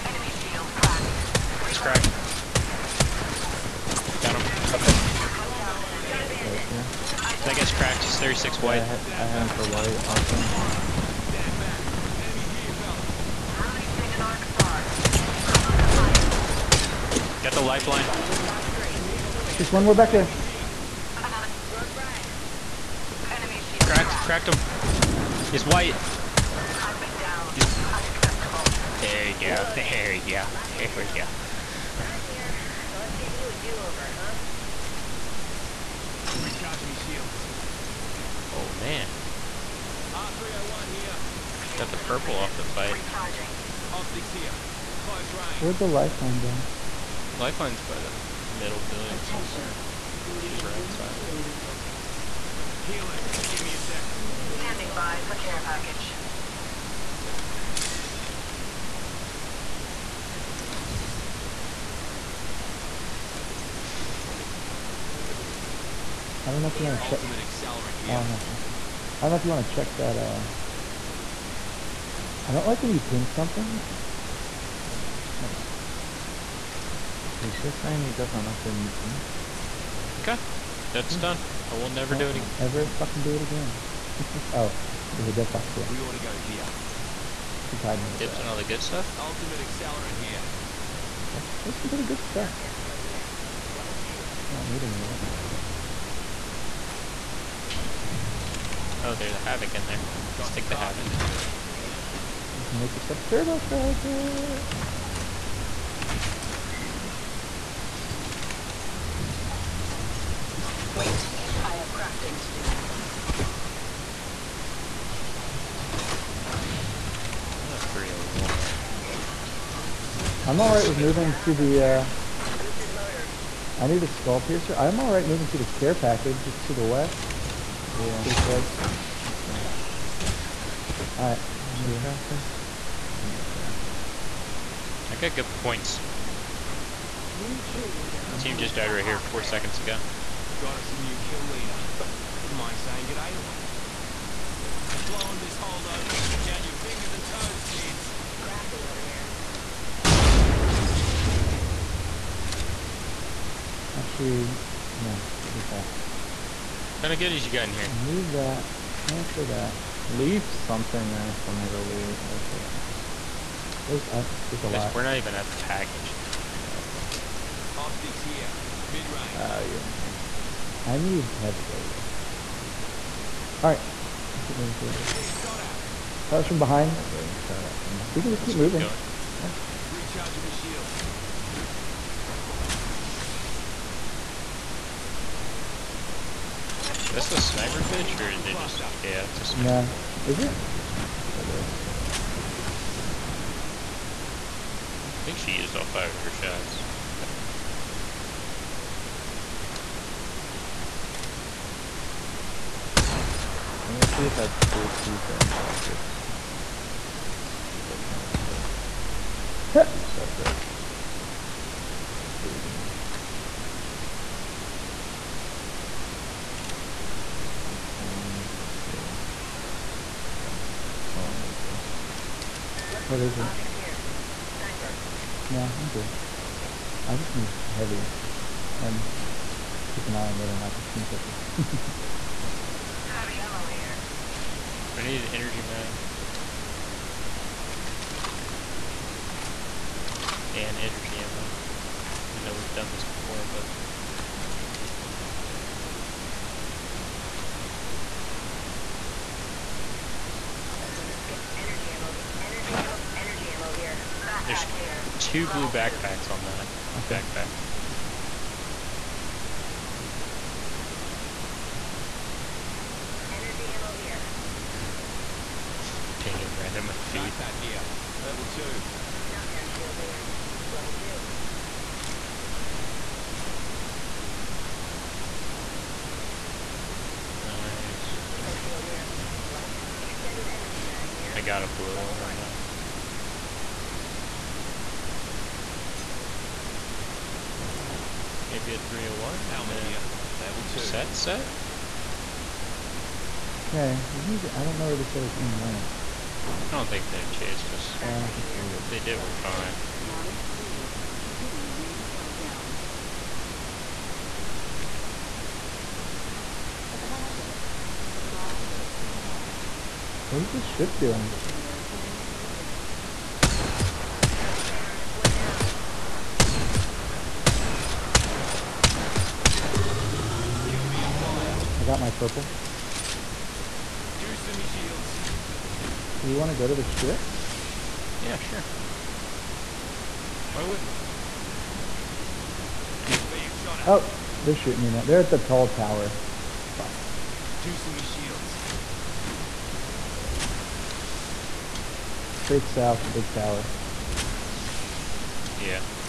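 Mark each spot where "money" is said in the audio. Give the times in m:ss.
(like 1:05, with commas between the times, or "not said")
not said.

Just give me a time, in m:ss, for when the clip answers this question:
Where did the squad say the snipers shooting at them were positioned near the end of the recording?
5:35.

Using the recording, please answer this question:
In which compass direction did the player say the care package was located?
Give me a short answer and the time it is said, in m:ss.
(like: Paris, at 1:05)
West, at 2:06.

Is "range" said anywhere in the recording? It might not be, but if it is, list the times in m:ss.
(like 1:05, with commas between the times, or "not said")
0:45, 2:49.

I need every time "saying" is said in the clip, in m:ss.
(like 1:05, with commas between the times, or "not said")
1:17, 2:22.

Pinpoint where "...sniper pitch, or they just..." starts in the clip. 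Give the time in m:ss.
3:07.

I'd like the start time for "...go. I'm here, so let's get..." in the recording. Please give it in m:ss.
0:31.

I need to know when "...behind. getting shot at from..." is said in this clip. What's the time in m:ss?
2:56.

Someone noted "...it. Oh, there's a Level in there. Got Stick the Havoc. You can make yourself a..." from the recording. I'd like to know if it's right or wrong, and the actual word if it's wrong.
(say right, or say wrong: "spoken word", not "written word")
wrong: "Havoc", not "Level".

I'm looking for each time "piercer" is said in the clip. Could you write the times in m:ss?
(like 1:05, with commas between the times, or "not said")
2:04.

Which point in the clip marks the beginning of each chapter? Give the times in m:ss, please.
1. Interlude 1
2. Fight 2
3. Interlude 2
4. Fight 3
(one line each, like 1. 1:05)
1. 0:35
2. 2:50
3. 3:45
4. 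5:05.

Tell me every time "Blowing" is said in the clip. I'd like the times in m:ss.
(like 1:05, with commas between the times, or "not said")
2:25.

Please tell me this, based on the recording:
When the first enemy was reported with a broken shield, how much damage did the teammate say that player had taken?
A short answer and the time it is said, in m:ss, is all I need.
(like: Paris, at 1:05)
36, at 0:08.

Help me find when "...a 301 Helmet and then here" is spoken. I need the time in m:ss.
4:48.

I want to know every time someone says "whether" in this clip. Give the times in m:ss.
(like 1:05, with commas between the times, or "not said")
3:50.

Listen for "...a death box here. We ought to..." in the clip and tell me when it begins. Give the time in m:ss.
1:25.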